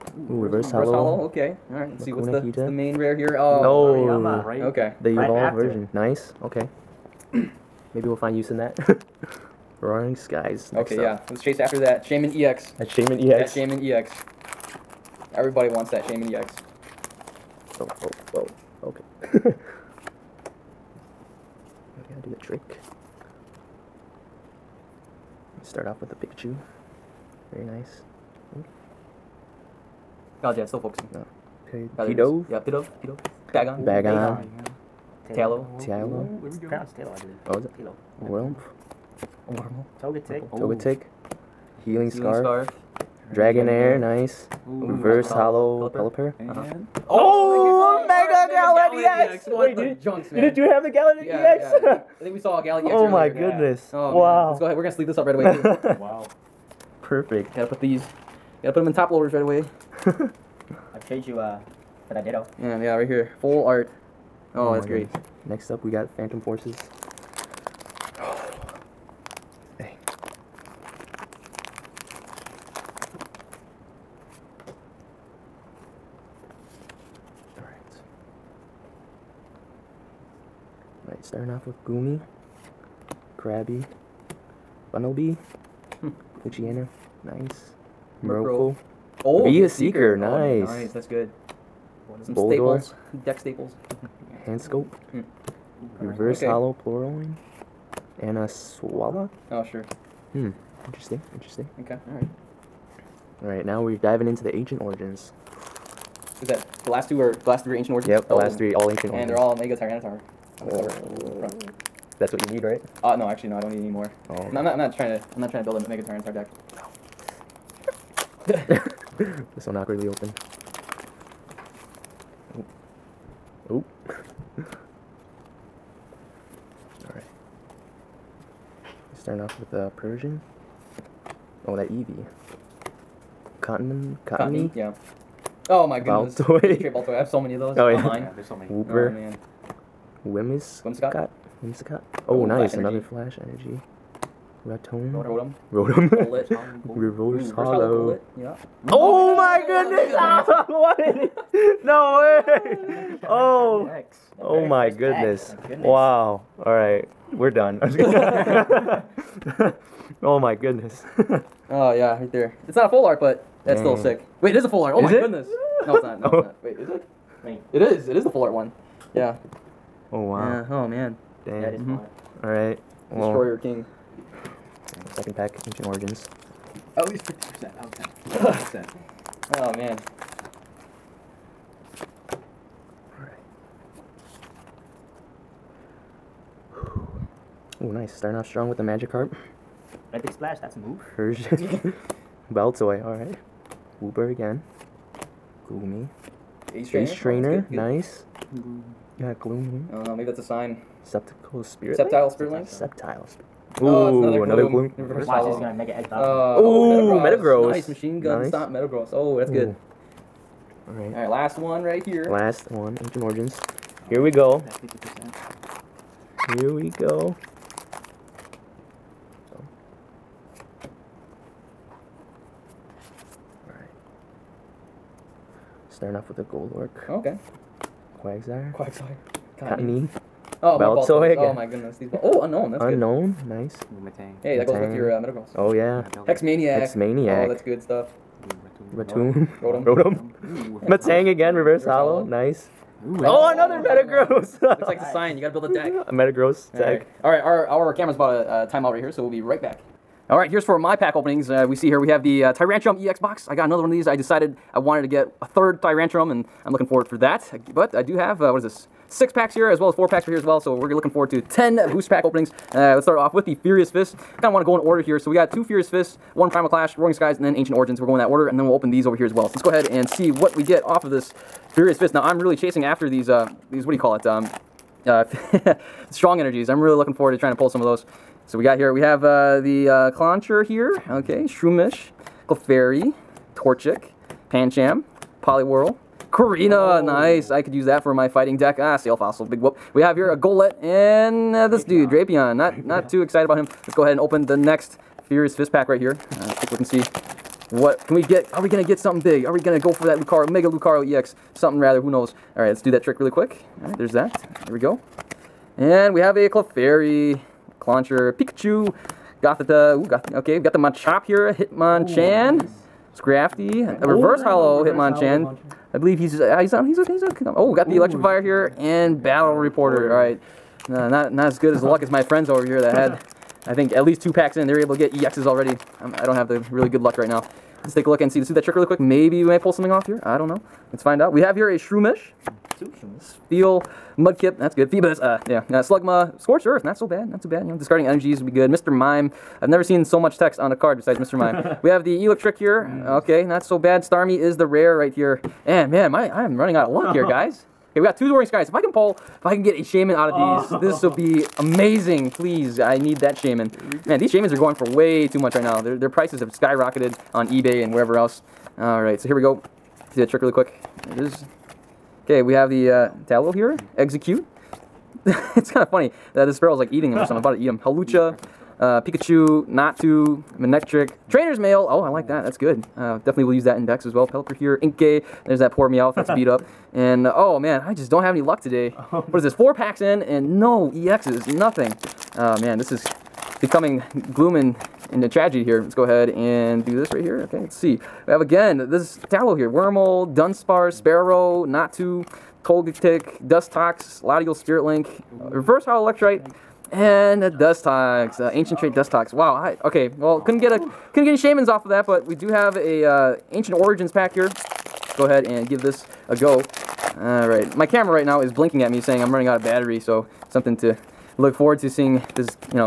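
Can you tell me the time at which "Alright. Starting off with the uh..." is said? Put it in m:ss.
2:07.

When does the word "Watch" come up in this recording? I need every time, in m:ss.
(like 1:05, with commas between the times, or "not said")
3:24.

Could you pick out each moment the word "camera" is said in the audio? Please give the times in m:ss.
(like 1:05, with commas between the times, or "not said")
4:07, 6:47.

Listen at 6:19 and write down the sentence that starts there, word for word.
Four packs in and no EXs, nothing.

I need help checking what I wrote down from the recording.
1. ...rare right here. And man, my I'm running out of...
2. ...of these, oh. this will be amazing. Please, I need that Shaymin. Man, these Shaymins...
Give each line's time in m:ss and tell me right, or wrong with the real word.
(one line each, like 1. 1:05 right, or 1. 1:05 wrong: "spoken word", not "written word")
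1. 5:44 right
2. 5:50 right.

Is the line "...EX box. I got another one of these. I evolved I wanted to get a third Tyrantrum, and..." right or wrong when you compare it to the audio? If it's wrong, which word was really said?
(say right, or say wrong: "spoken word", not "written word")
wrong: "decided", not "evolved".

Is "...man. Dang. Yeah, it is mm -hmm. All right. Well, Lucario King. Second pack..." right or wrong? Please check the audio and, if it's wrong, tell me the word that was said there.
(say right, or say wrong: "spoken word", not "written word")
wrong: "Destroyer", not "Lucario".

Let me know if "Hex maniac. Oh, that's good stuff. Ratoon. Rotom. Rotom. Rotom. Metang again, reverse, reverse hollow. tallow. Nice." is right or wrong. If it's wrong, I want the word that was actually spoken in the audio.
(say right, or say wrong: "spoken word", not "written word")
wrong: "hollow", not "tallow".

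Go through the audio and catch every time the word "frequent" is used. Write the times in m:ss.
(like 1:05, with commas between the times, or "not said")
not said.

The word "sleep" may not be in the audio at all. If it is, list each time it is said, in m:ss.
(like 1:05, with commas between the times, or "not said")
0:54.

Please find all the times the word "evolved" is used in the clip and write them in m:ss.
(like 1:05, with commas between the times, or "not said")
0:05.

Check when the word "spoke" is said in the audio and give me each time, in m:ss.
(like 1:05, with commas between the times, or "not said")
not said.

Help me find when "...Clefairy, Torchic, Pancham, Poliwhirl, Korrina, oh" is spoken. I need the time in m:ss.
4:42.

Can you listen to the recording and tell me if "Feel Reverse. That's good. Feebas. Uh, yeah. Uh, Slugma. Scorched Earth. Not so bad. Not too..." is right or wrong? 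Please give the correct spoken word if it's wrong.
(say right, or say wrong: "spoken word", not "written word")
wrong: "Mudkip", not "Reverse".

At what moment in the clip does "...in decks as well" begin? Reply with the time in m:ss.
6:13.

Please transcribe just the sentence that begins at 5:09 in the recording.
Ooh, Goth okay, we've got the Machop here, Hitmonchan, Ooh, nice.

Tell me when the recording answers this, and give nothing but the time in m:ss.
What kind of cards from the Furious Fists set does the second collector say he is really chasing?
4:36.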